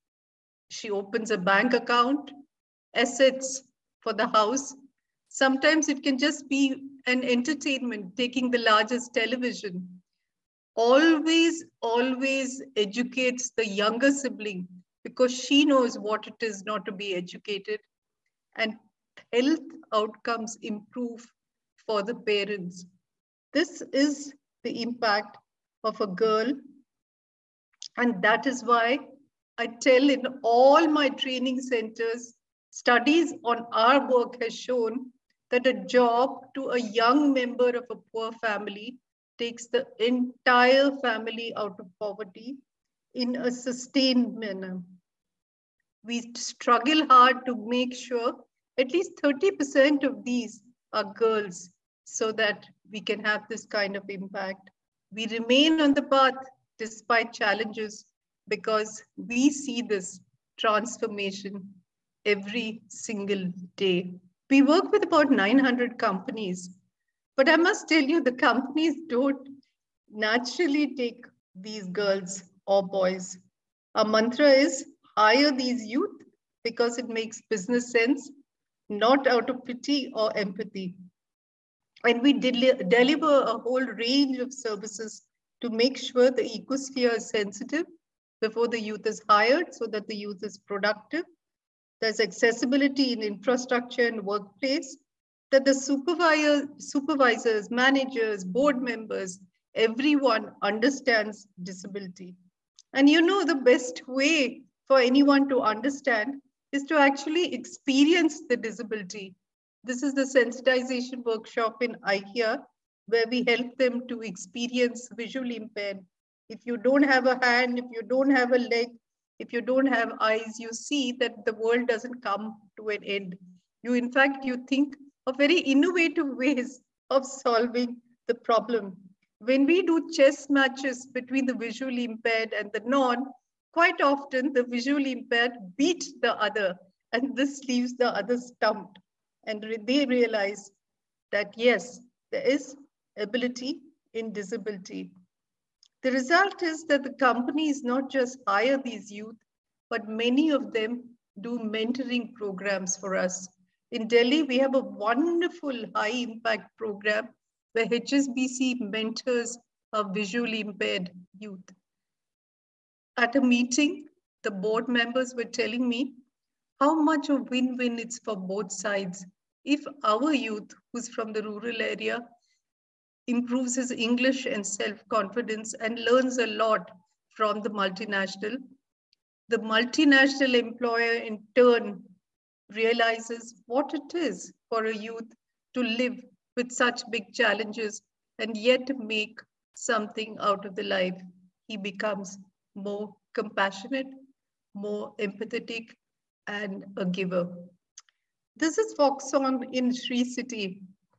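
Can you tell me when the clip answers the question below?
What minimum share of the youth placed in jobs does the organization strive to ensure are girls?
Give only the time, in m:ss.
0:49.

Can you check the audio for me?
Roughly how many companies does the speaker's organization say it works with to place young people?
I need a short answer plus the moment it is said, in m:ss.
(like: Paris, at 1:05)
900, at 1:05.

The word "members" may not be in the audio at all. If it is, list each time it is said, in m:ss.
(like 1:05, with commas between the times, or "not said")
0:37, 1:38, 2:44.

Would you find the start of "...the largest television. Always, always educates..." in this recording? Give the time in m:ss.
0:08.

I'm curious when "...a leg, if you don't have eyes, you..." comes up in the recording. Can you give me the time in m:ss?
1:58.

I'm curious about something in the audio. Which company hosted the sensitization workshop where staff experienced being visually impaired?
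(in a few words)
IKEA.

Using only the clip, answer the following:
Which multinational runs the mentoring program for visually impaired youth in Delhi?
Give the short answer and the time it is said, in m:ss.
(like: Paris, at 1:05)
HSBC, at 2:37.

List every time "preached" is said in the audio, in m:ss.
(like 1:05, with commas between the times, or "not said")
not said.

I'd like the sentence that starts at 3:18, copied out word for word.
This is Foxconn in Sri City.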